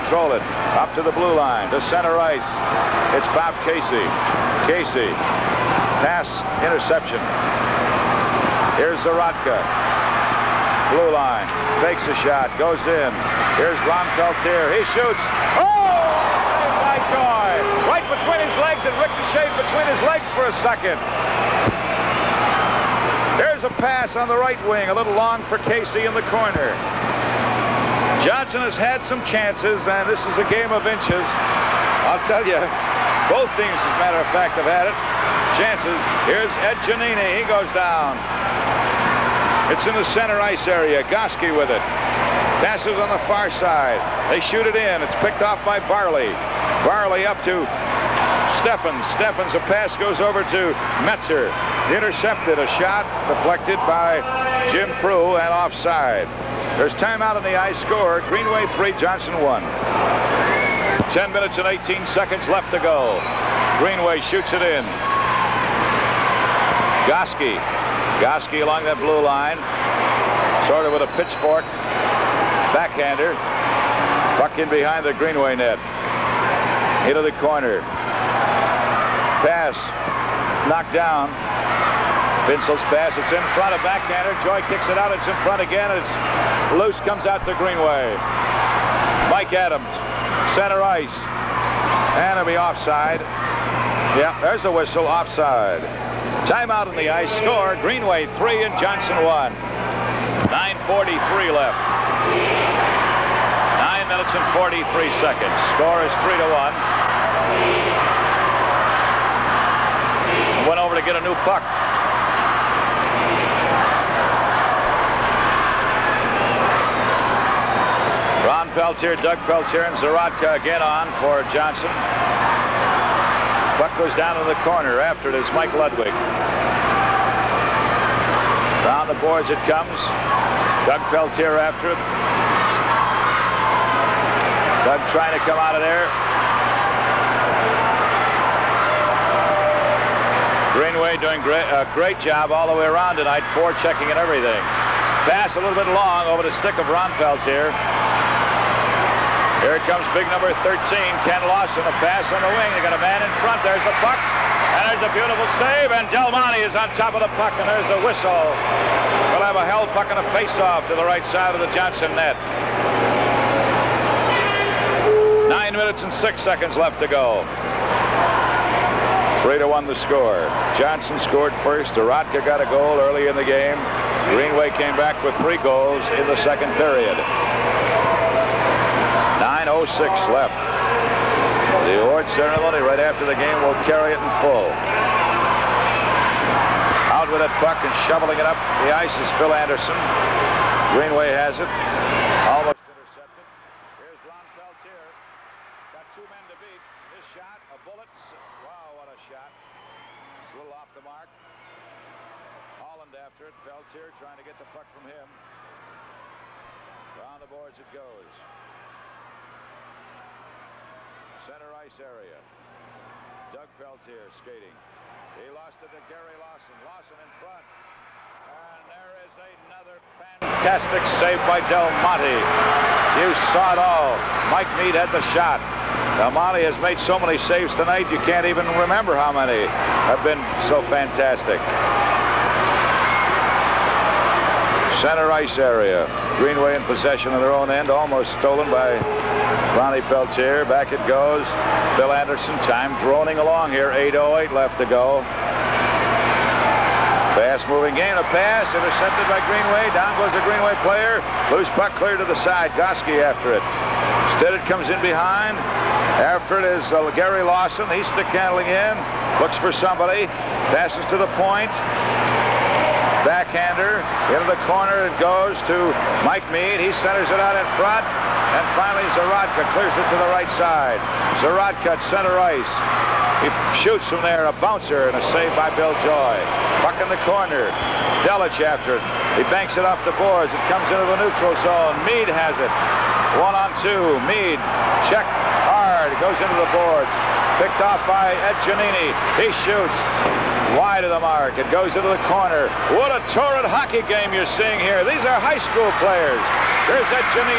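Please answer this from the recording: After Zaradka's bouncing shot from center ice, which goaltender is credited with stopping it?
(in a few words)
Bill Joy.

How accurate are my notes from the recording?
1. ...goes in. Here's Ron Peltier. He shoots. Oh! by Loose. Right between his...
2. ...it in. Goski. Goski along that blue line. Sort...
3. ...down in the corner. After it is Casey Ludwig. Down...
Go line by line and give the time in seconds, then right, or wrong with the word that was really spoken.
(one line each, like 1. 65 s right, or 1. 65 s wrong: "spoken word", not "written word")
1. 12 s wrong: "Joy", not "Loose"
2. 64 s right
3. 124 s wrong: "Mike", not "Casey".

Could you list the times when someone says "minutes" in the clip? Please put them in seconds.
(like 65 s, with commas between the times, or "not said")
61 s, 104 s, 165 s.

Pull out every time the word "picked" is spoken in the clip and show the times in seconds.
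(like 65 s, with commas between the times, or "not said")
45 s, 287 s.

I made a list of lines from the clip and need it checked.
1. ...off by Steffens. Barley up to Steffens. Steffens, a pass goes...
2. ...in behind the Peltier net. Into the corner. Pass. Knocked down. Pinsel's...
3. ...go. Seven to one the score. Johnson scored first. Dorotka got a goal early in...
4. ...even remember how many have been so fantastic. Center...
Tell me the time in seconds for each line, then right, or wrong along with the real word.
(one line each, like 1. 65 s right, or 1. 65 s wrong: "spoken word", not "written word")
1. 45 s wrong: "Barley", not "Steffens"
2. 74 s wrong: "Greenway", not "Peltier"
3. 167 s wrong: "Three", not "Seven"
4. 228 s right.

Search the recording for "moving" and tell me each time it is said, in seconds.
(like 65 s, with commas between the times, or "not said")
247 s.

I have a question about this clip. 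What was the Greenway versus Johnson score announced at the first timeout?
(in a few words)
3-1.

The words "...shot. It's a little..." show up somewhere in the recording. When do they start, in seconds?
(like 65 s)
199 s.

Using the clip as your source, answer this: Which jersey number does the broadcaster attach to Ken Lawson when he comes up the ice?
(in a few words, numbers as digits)
13.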